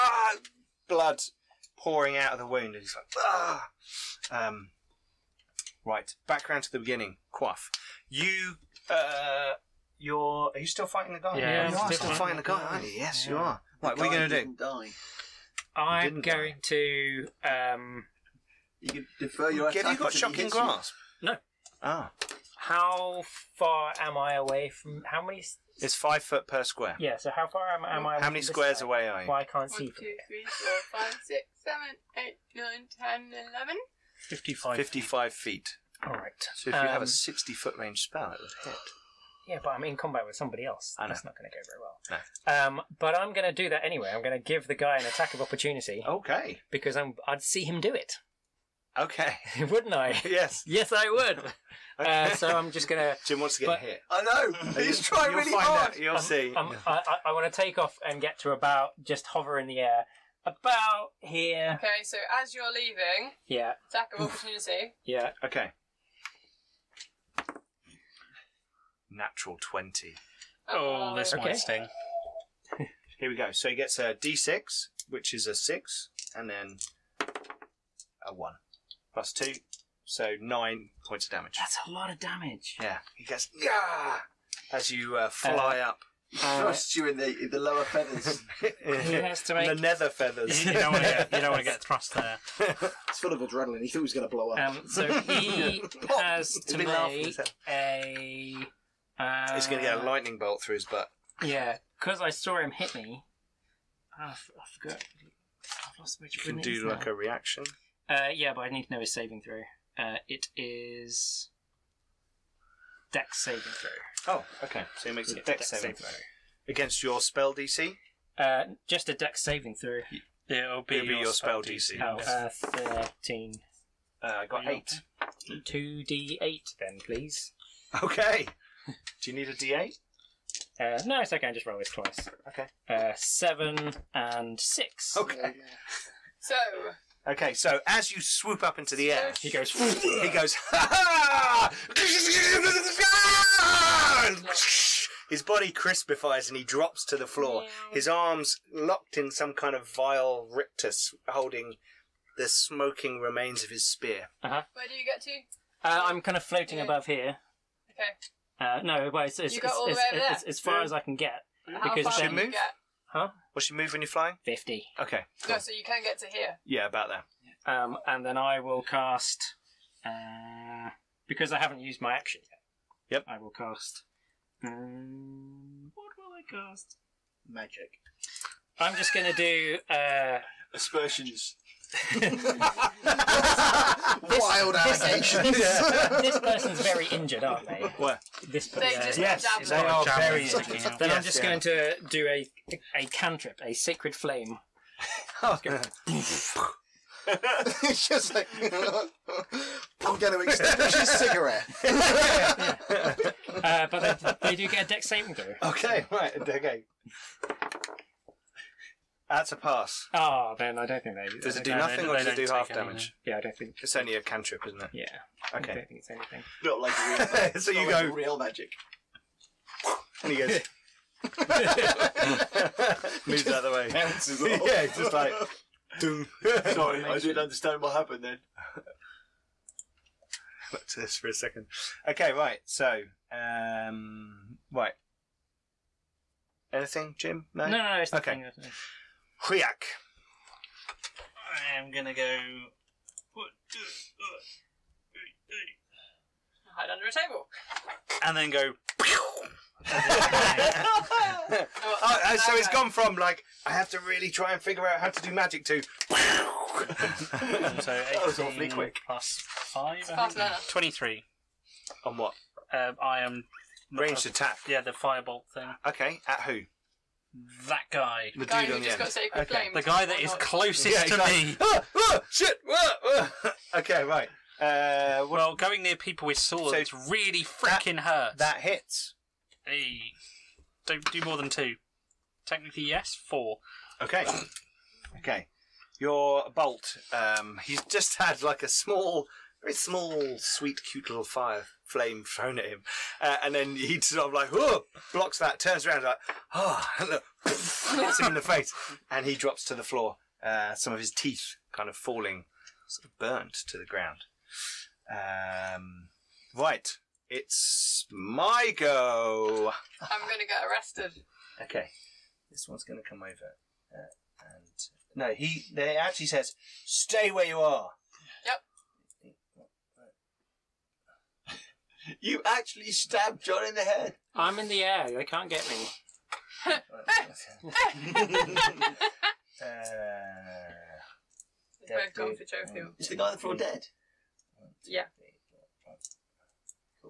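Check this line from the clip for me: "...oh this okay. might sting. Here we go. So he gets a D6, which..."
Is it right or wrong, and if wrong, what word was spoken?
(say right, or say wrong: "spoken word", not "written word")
right.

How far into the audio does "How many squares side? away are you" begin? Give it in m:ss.
0:28.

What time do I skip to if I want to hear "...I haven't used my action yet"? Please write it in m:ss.
2:51.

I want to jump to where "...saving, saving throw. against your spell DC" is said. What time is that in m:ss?
1:55.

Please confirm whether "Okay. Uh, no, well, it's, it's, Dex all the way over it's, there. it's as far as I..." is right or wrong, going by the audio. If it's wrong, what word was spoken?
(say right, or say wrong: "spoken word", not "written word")
wrong: "You", not "Dex".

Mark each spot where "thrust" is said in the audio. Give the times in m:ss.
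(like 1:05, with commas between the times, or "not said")
1:26, 1:31.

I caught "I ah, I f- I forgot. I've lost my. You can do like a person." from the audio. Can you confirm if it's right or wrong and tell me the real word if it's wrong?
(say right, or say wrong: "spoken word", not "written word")
wrong: "reaction", not "person".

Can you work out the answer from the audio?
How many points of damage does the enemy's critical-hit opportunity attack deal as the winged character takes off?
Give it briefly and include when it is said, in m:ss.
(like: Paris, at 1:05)
9, at 1:20.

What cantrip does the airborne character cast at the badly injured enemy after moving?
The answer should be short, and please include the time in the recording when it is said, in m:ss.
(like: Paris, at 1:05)
Sacred Flame, at 3:13.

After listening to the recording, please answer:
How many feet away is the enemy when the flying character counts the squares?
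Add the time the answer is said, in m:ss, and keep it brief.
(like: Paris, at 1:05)
55 feet, at 0:34.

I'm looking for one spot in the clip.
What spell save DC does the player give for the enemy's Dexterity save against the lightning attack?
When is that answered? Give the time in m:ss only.
2:02.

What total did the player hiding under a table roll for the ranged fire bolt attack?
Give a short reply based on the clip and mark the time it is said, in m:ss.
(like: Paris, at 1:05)
23, at 4:20.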